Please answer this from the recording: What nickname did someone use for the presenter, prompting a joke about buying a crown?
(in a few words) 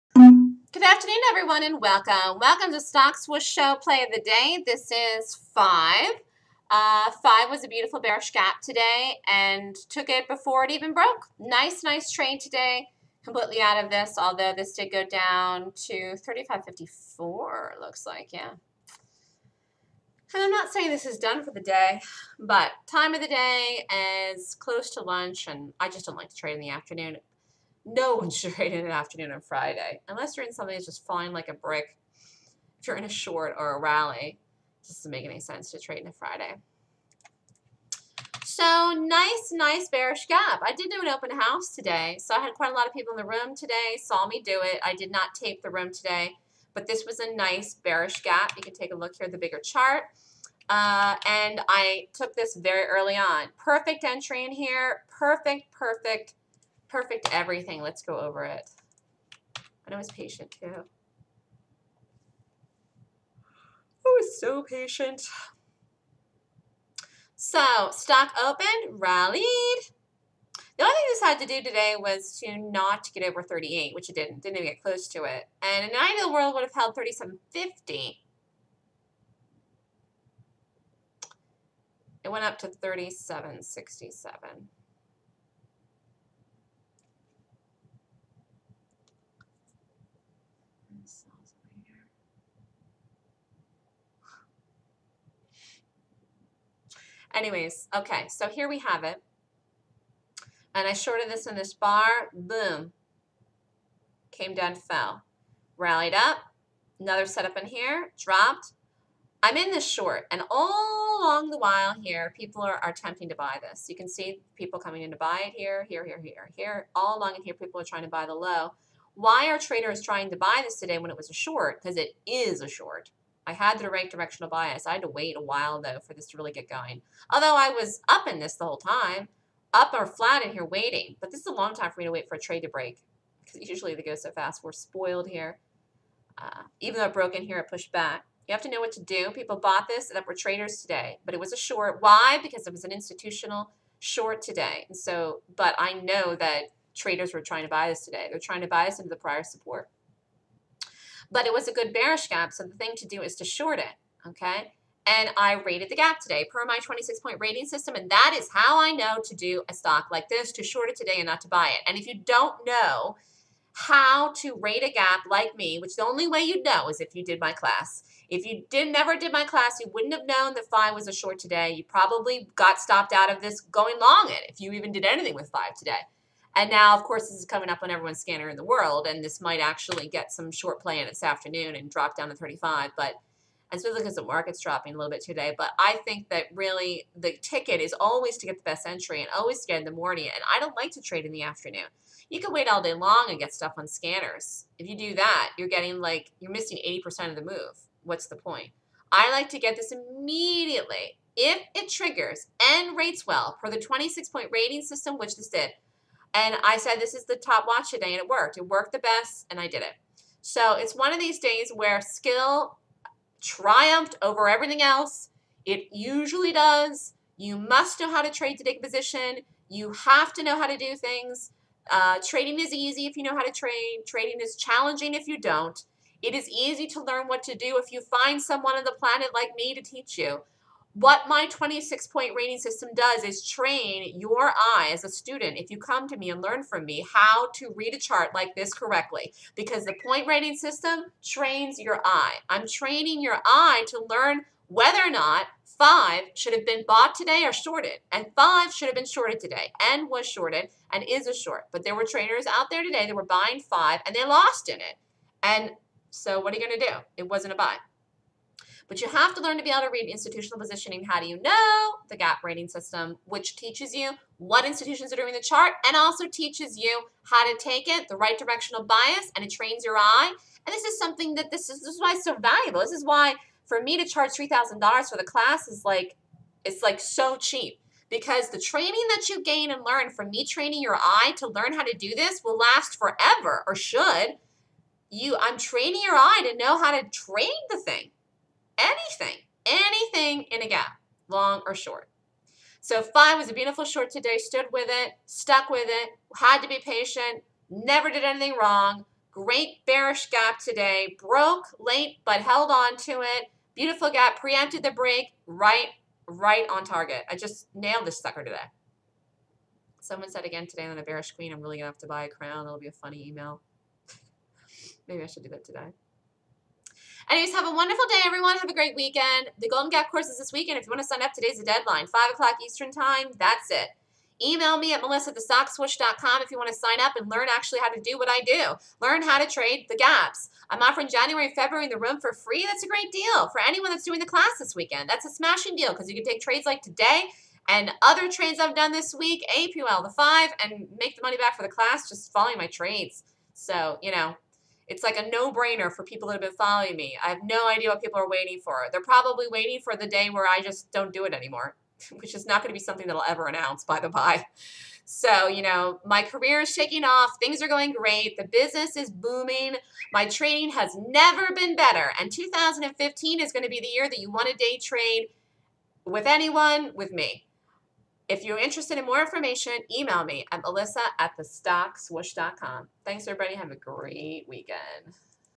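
the bearish queen.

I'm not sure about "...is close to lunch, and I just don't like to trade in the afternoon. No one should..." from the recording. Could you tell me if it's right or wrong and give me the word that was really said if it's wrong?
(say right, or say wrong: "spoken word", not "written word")
right.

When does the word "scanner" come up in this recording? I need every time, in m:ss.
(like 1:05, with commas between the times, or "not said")
2:58, 3:13.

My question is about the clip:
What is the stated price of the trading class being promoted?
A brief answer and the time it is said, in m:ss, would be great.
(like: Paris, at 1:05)
$3,000, at 4:34.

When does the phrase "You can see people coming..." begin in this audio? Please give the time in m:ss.
1:53.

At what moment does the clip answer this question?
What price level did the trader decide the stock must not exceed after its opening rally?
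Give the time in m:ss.
1:13.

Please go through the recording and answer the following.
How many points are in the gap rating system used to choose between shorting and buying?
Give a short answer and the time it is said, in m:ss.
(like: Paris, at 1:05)
26, at 2:36.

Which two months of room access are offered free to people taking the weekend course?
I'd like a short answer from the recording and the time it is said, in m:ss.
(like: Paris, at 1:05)
January and February, at 5:31.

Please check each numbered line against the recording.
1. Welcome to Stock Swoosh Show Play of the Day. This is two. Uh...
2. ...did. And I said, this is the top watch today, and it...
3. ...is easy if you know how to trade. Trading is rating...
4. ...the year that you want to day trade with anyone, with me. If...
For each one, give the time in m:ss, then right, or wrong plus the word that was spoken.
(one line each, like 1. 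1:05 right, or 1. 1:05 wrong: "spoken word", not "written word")
1. 0:02 wrong: "five", not "two"
2. 3:25 right
3. 3:42 wrong: "challenging", not "rating"
4. 6:03 right.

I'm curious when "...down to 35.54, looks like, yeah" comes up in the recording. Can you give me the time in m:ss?
0:15.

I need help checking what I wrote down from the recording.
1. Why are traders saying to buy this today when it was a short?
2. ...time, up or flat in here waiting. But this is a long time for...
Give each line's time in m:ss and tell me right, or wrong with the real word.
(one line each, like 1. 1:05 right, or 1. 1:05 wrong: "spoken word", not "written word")
1. 1:59 wrong: "trying", not "saying"
2. 2:08 right.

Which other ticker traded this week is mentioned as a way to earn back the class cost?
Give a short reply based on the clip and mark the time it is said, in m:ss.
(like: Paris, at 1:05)
APL, at 5:39.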